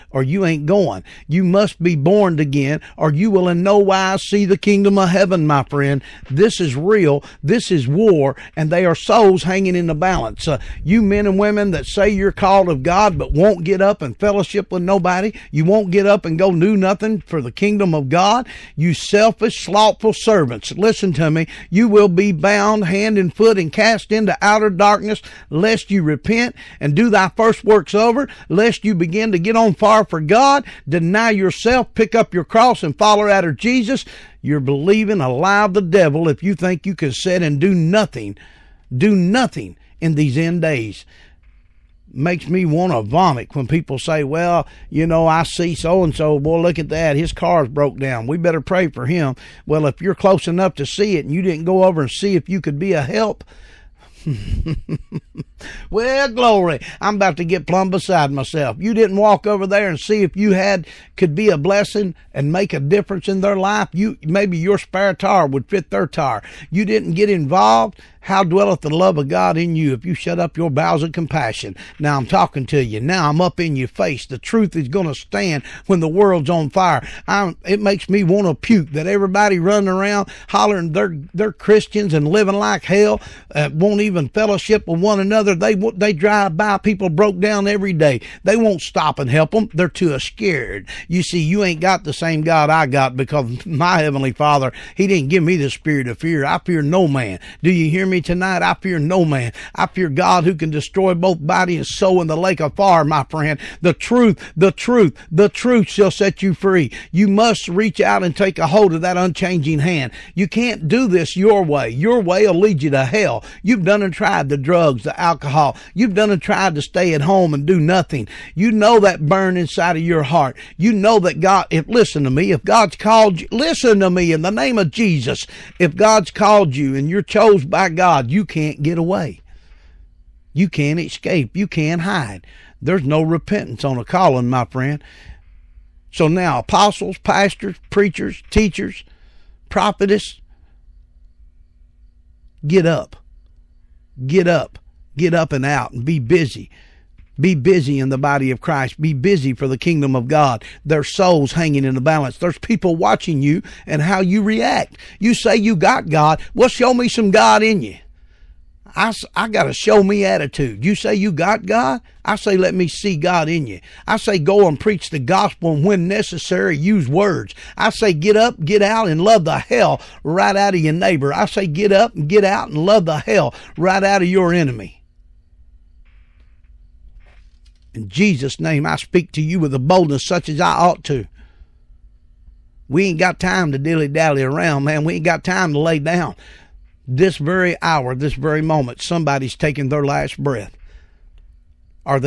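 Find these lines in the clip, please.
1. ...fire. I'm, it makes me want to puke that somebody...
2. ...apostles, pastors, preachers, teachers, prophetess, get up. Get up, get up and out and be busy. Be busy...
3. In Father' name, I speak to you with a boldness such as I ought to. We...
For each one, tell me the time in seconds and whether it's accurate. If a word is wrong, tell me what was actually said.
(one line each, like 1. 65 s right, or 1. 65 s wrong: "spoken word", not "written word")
1. 76 s wrong: "everybody", not "somebody"
2. 136 s right
3. 177 s wrong: "Jesus", not "Father".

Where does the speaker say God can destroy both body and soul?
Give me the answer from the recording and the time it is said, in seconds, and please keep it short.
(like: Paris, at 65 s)
lake of fire, at 102 s.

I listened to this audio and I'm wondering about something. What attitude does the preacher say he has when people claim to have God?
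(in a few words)
show me attitude.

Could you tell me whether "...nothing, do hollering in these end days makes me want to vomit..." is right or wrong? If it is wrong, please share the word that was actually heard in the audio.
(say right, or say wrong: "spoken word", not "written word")
wrong: "nothing", not "hollering".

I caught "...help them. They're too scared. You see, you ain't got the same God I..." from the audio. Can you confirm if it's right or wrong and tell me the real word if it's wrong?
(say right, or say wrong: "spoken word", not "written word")
right.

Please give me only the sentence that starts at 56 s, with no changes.
I'm about to get plumb beside myself.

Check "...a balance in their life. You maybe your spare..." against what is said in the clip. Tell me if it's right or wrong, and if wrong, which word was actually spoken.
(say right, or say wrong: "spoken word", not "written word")
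wrong: "difference", not "balance".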